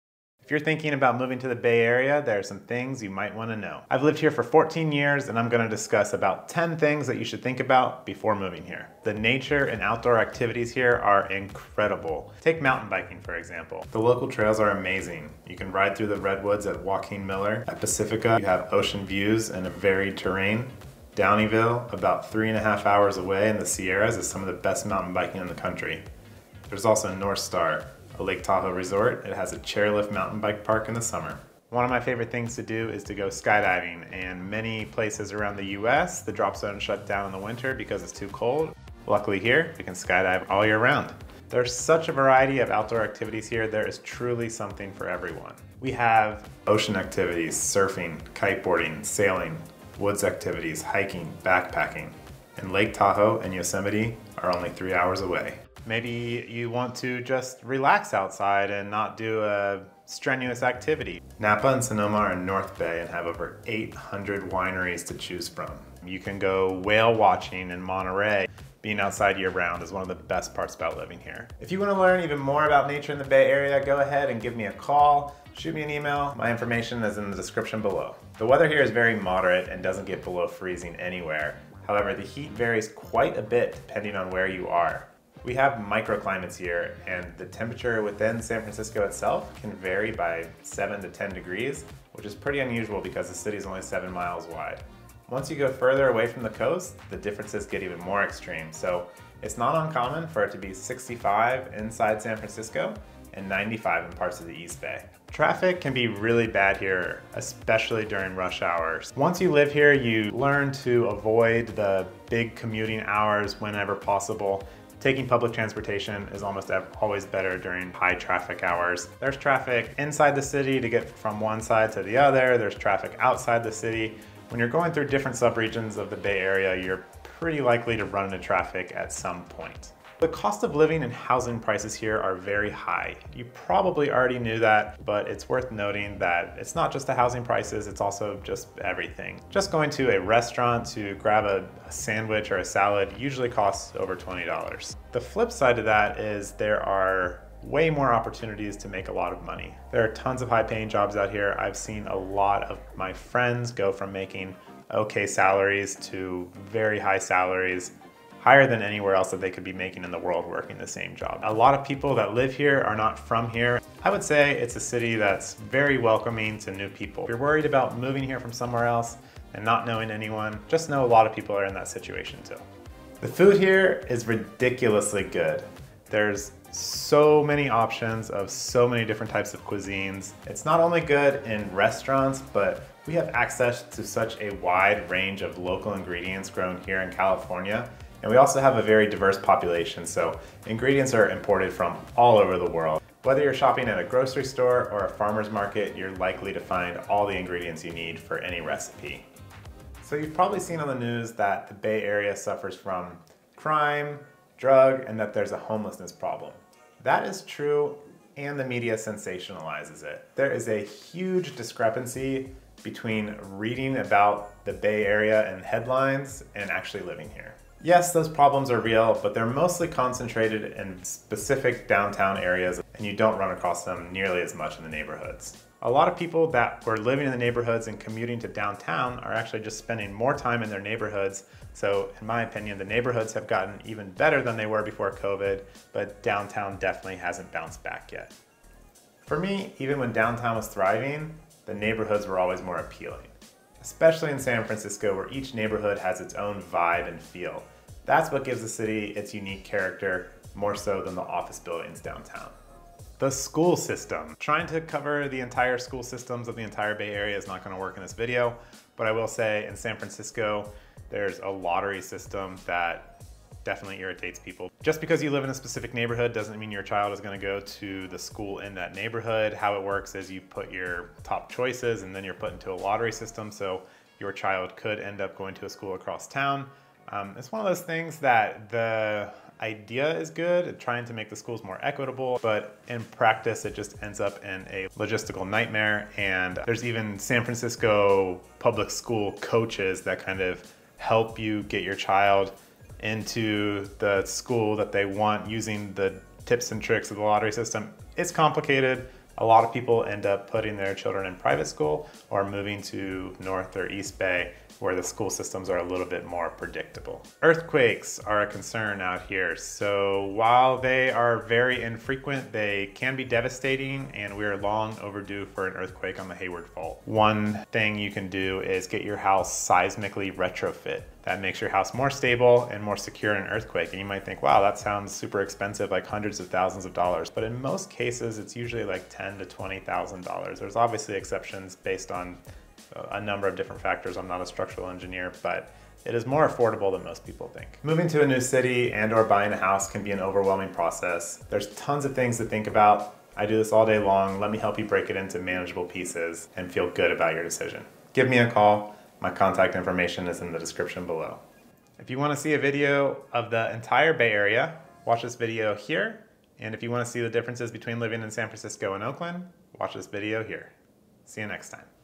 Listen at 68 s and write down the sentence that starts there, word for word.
Being outside year round is one of the best parts about living here.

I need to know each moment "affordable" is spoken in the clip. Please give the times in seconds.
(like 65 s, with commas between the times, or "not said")
336 s.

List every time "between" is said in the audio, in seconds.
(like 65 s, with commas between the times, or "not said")
212 s, 357 s.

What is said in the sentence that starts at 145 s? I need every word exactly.
The flip side of that is there are way more opportunities to make a lot of money.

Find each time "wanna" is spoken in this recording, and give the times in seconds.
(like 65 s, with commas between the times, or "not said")
3 s, 71 s, 352 s, 356 s.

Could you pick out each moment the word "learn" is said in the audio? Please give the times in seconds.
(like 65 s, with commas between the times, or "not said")
71 s, 110 s.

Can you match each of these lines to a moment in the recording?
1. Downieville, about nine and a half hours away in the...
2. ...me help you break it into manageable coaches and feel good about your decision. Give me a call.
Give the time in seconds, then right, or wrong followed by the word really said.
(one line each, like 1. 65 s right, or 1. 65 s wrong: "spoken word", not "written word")
1. 21 s wrong: "three", not "nine"
2. 344 s wrong: "pieces", not "coaches".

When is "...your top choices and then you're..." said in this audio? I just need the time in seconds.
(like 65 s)
270 s.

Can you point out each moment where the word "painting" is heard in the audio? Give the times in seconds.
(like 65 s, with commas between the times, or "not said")
not said.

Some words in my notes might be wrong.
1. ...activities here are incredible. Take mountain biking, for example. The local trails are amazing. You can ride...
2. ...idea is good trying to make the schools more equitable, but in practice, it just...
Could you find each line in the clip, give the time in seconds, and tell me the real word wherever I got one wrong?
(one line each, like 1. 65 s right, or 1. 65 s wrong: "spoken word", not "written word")
1. 10 s right
2. 279 s right.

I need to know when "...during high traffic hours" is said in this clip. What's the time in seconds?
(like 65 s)
117 s.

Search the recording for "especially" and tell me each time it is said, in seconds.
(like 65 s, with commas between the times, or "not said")
107 s, 243 s.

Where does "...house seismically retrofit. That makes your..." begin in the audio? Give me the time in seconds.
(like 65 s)
319 s.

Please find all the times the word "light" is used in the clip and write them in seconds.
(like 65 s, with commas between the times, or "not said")
not said.